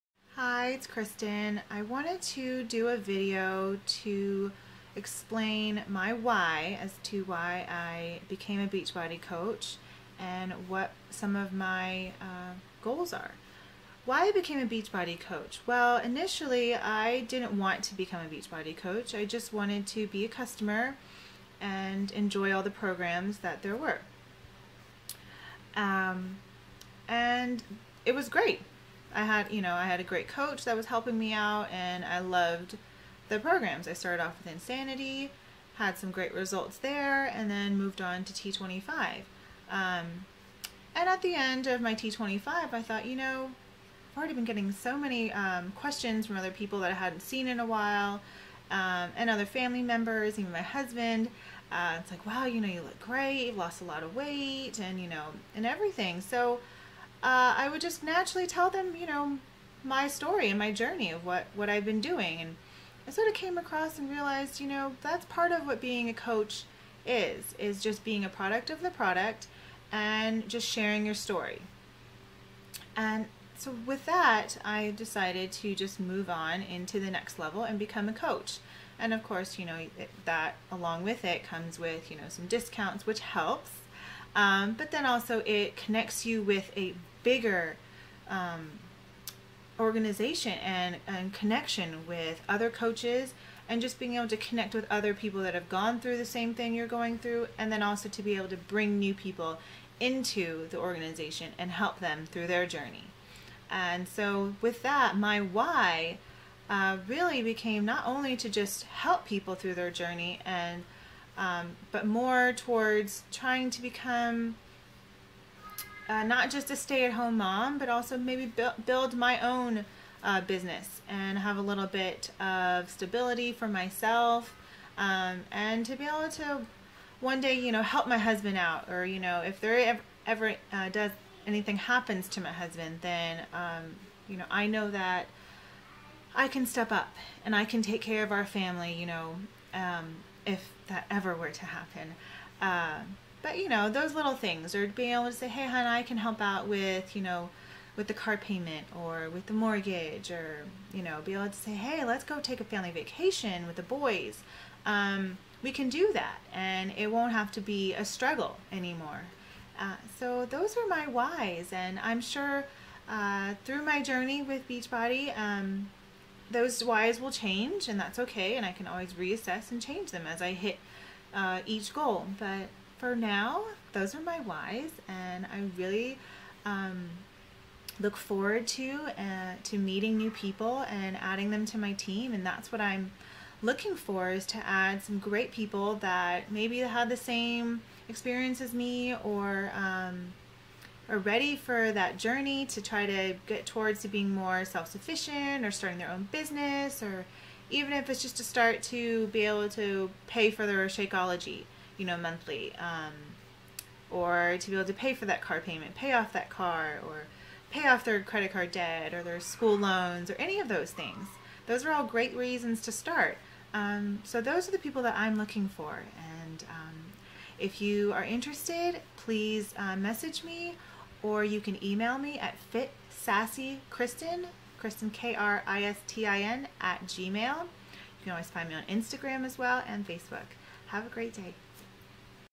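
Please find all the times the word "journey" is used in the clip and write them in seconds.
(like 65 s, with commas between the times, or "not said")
60 s, 102 s, 109 s, 164 s, 192 s.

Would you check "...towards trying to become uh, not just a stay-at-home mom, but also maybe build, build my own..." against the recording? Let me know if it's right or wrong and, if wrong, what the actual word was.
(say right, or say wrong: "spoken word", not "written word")
right.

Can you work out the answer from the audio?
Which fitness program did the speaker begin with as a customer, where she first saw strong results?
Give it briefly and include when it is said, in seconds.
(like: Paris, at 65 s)
Insanity, at 34 s.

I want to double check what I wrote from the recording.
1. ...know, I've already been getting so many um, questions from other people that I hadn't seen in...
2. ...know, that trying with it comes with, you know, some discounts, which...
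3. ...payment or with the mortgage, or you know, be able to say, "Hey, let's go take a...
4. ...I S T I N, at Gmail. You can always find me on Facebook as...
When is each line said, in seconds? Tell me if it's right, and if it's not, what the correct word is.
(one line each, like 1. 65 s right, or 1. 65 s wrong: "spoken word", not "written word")
1. 43 s right
2. 79 s wrong: "along", not "trying"
3. 148 s right
4. 225 s wrong: "Instagram", not "Facebook".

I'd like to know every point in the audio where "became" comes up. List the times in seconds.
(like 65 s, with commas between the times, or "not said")
8 s, 14 s, 107 s.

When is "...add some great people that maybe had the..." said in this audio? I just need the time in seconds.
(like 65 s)
184 s.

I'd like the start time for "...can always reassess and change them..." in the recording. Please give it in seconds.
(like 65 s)
168 s.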